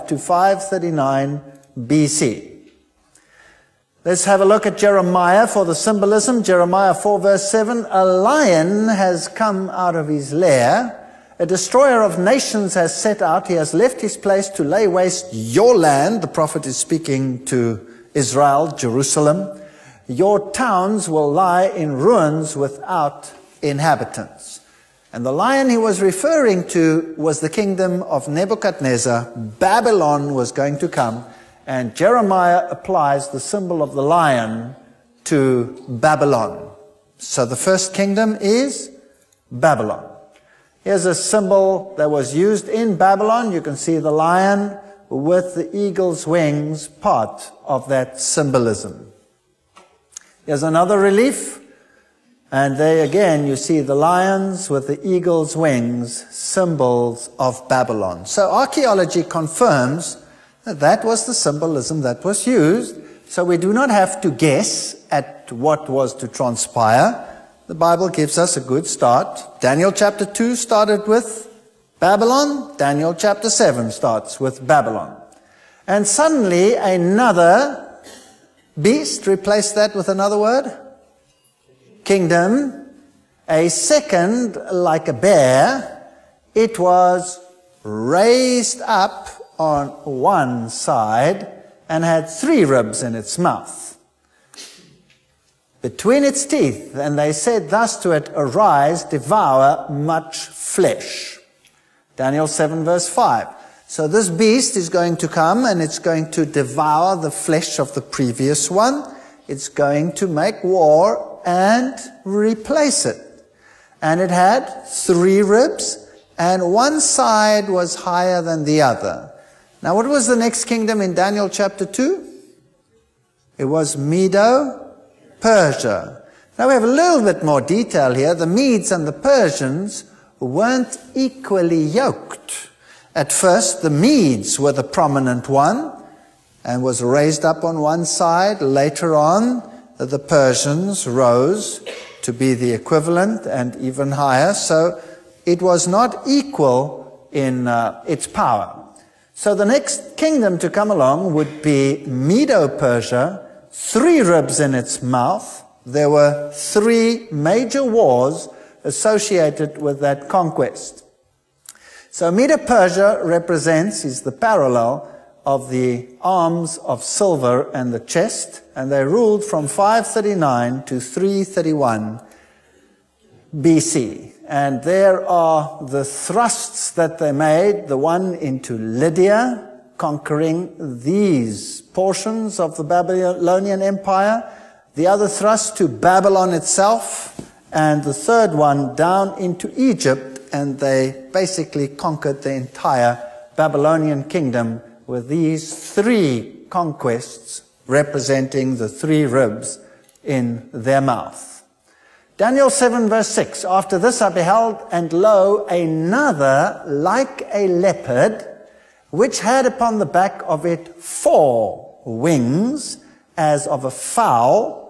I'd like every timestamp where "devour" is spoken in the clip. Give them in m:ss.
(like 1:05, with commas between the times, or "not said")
1:39, 1:46.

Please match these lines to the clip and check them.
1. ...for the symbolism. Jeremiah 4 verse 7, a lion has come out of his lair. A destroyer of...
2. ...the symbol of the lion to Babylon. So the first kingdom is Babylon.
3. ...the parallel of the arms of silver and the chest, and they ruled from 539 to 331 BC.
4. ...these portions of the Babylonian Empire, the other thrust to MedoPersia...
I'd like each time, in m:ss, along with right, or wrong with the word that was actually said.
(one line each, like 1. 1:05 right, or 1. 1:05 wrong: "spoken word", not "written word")
1. 0:05 right
2. 0:33 right
3. 2:44 right
4. 3:01 wrong: "Babylon", not "MedoPersia".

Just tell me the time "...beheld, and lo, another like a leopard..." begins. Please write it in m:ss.
3:24.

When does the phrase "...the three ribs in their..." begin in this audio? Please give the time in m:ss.
3:18.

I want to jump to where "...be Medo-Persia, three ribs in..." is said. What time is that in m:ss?
2:31.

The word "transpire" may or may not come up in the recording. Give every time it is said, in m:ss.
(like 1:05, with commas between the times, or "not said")
1:06.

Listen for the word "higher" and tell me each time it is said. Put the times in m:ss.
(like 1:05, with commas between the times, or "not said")
1:57, 2:24.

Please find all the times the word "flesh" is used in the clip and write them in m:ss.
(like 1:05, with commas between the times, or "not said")
1:40, 1:47.